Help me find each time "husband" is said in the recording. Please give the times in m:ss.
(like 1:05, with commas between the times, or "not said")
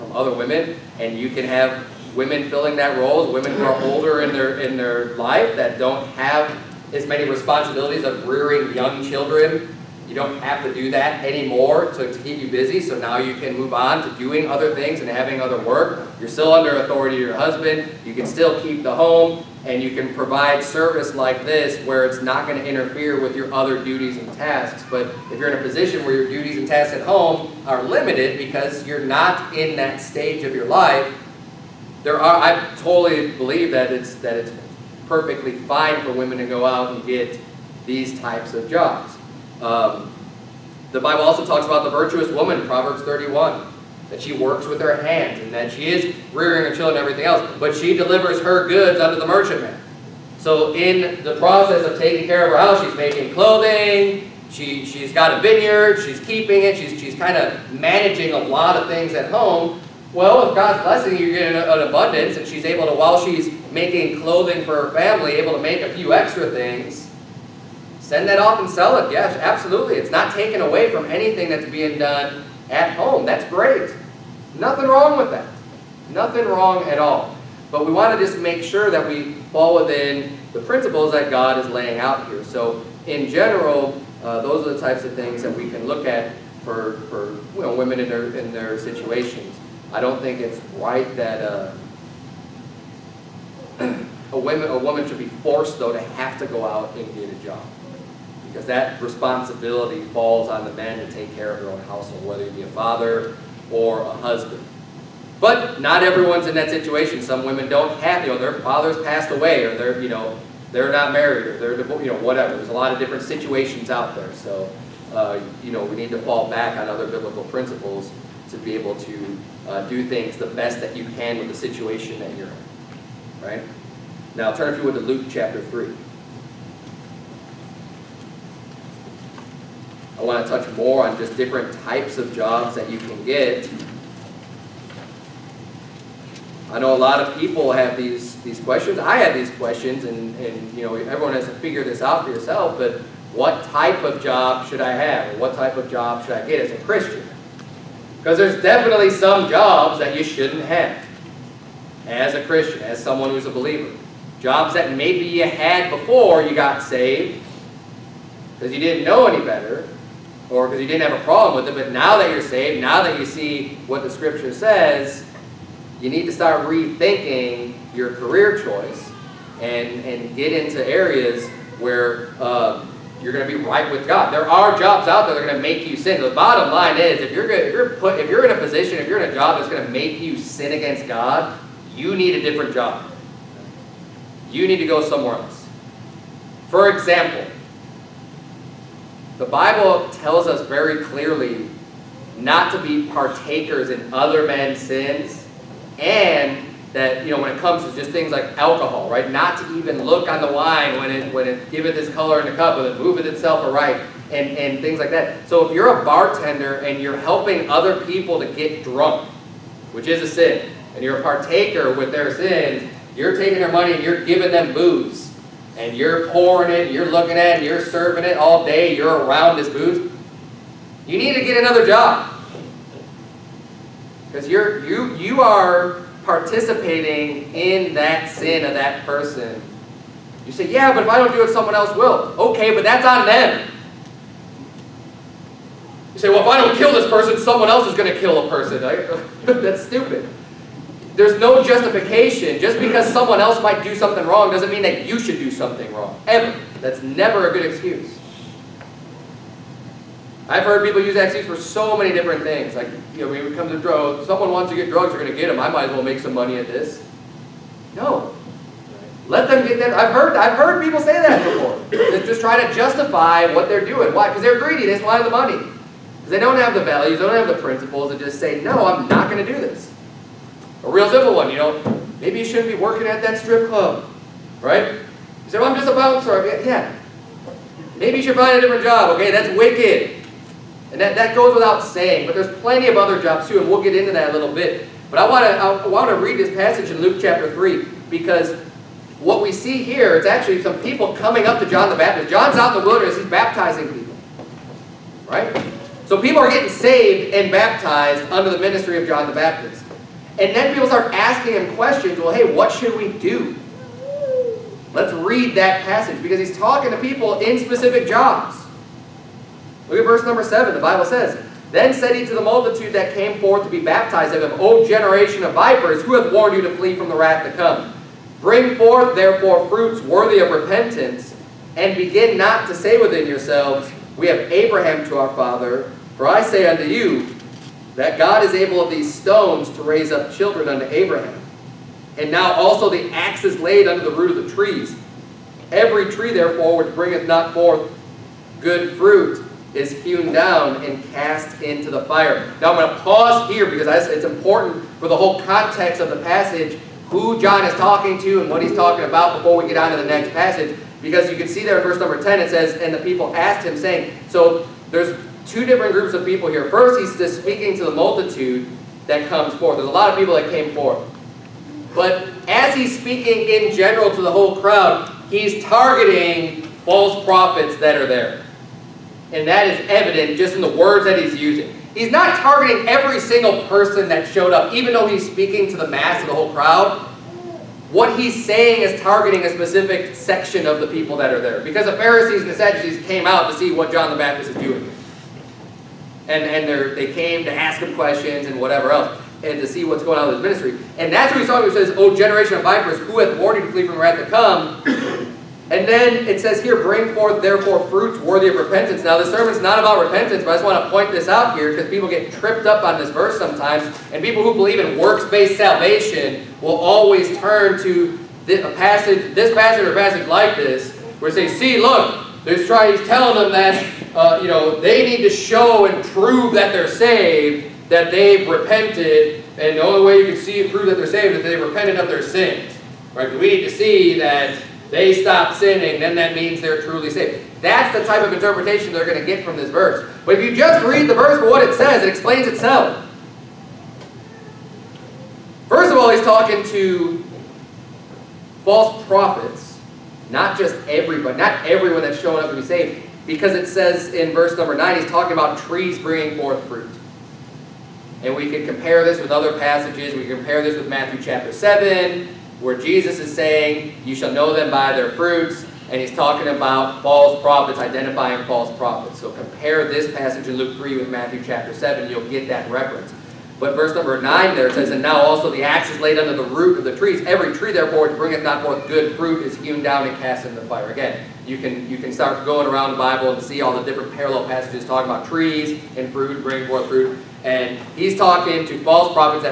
0:17, 1:44.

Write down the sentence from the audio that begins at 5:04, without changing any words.
Let's read that passage because he's talking to people in specific jobs.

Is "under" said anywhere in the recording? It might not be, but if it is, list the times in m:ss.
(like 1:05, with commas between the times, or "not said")
0:16, 4:58, 5:33, 7:46.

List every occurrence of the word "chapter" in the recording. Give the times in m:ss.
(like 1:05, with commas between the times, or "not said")
2:05, 4:47, 7:31, 7:41.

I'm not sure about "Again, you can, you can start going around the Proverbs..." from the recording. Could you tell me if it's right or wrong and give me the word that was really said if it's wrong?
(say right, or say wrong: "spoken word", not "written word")
wrong: "Bible", not "Proverbs".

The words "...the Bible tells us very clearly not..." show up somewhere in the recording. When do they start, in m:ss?
3:09.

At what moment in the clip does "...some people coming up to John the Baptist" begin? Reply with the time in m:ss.
4:50.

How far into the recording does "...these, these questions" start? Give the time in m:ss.
2:17.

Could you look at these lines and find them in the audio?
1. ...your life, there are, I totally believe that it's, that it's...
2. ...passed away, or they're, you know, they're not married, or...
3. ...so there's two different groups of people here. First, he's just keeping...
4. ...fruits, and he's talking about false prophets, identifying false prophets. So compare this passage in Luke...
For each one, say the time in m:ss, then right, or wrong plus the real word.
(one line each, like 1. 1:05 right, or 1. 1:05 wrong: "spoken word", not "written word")
1. 0:30 right
2. 1:49 right
3. 5:54 wrong: "speaking", not "keeping"
4. 7:35 right.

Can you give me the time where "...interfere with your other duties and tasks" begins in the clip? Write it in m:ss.
0:22.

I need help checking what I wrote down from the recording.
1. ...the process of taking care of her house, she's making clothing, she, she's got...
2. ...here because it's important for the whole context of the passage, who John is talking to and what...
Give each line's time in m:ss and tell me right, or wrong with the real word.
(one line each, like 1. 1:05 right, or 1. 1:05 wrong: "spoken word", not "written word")
1. 0:51 right
2. 5:43 right.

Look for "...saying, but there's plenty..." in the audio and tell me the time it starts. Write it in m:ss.
4:41.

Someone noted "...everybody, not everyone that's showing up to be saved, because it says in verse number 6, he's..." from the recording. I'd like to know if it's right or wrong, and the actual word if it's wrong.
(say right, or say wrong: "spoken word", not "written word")
wrong: "9", not "6".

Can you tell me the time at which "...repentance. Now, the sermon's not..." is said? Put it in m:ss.
6:38.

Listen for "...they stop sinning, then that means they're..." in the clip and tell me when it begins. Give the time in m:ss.
7:04.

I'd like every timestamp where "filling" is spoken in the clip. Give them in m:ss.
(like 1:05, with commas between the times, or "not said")
0:02.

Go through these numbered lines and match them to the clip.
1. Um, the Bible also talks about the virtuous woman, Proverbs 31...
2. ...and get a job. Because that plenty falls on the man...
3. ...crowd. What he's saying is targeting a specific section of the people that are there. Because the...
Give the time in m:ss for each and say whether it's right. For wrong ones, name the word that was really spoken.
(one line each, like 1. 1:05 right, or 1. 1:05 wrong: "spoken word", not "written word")
1. 0:39 right
2. 1:36 wrong: "responsibility", not "plenty"
3. 6:16 right.